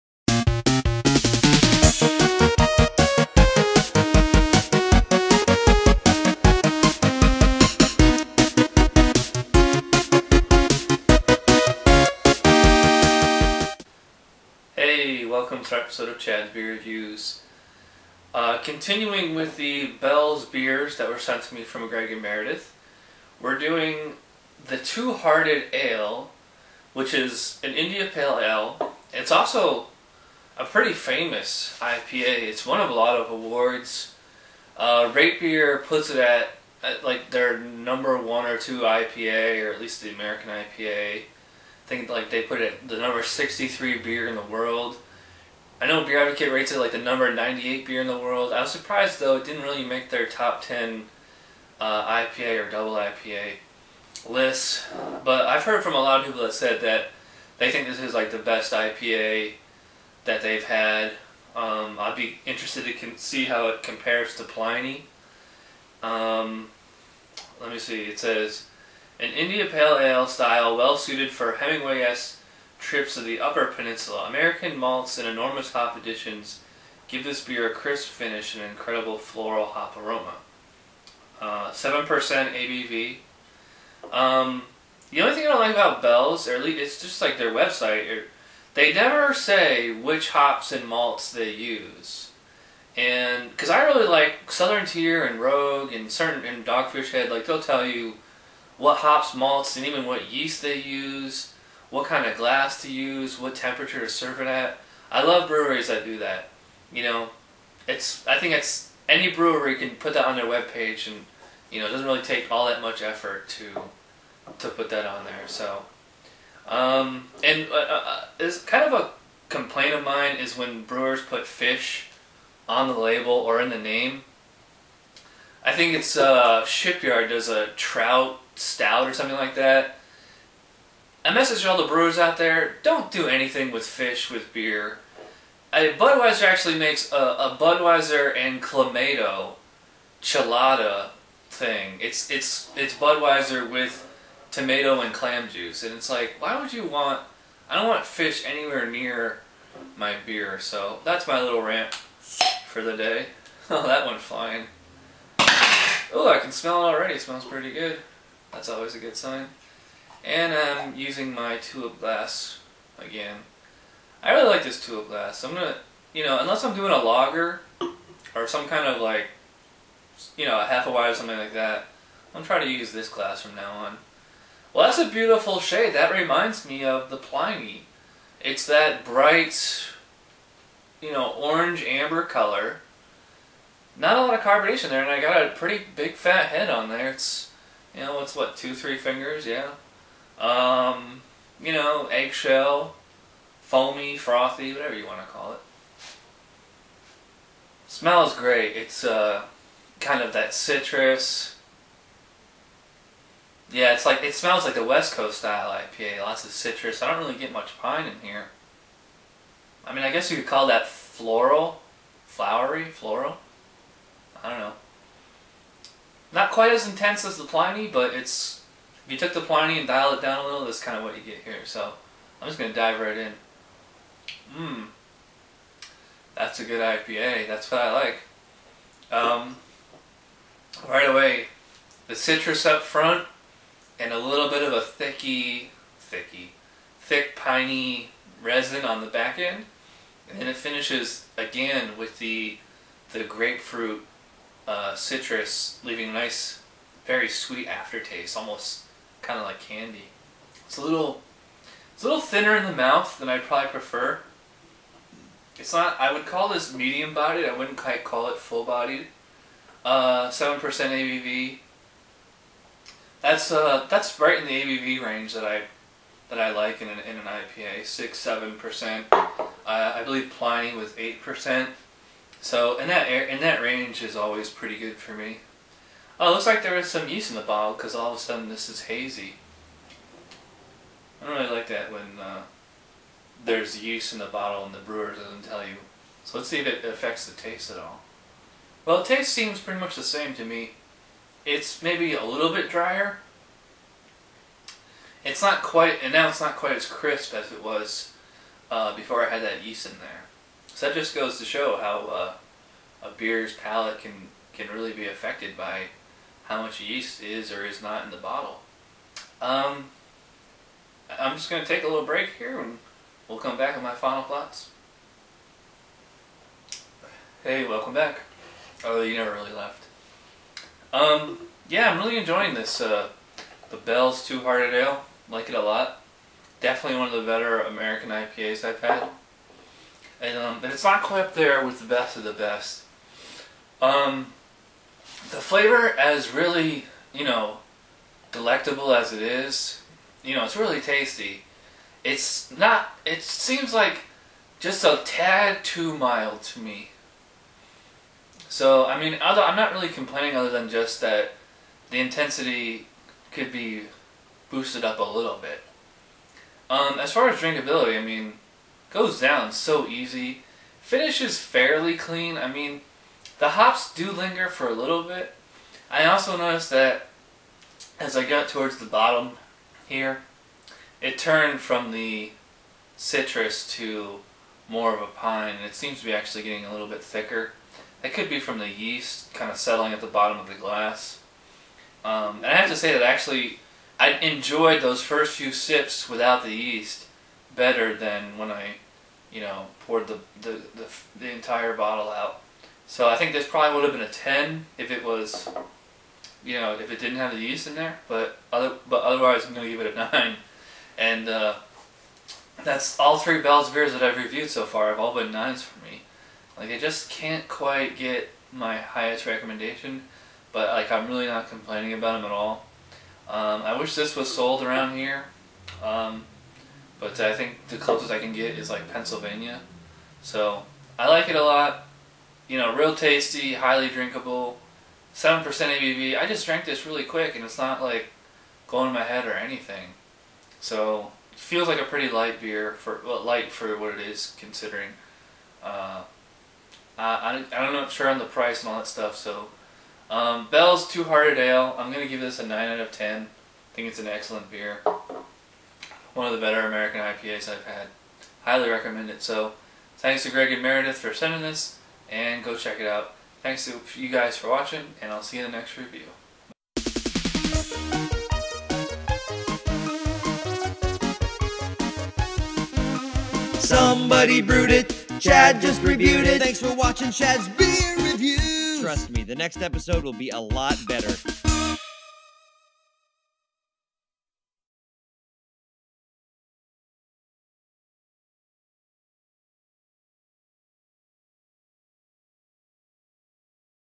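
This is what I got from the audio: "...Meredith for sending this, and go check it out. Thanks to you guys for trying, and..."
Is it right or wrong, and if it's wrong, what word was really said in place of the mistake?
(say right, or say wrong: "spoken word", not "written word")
wrong: "watching", not "trying".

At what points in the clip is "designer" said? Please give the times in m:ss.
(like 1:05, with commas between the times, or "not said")
not said.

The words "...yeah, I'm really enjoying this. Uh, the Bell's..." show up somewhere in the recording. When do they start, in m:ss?
5:21.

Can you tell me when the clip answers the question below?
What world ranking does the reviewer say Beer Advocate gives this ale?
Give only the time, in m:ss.
0:46.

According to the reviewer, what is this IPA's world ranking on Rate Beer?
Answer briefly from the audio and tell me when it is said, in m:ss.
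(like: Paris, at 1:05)
63, at 0:42.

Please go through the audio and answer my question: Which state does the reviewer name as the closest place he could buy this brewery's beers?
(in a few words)
Pennsylvania.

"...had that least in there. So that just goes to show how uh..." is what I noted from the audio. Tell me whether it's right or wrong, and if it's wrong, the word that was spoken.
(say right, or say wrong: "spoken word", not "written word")
wrong: "yeast", not "least".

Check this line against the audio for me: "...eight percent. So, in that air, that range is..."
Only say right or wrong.
right.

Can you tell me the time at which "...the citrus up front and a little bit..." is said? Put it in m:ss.
3:52.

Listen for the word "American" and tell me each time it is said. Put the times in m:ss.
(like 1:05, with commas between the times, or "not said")
0:40, 1:14, 5:27, 7:26.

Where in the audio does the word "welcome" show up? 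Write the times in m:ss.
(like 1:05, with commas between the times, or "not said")
0:15, 5:17.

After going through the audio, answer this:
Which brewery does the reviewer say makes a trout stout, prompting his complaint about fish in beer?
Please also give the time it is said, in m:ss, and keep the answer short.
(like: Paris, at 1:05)
Shipyard, at 2:06.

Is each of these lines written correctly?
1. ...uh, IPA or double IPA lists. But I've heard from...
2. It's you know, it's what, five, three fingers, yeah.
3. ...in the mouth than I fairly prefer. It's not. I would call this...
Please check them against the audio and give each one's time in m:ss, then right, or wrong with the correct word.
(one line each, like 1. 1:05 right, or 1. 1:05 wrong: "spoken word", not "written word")
1. 0:51 right
2. 3:07 wrong: "two", not "five"
3. 4:12 wrong: "probably", not "fairly".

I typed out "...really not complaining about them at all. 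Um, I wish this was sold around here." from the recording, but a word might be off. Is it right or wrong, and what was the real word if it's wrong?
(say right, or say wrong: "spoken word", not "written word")
right.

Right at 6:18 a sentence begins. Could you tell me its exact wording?
That could be from the yeast kind of settling at the bottom of the glass.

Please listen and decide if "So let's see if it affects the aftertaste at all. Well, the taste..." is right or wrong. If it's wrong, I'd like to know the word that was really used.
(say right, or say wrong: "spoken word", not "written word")
wrong: "taste", not "aftertaste".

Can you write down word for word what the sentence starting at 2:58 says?
It's that bright, you know, orange amber color.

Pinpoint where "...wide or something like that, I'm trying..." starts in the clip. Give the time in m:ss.
2:50.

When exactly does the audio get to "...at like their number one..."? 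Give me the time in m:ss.
0:36.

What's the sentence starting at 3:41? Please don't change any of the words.
So I'm just gonna dive right in.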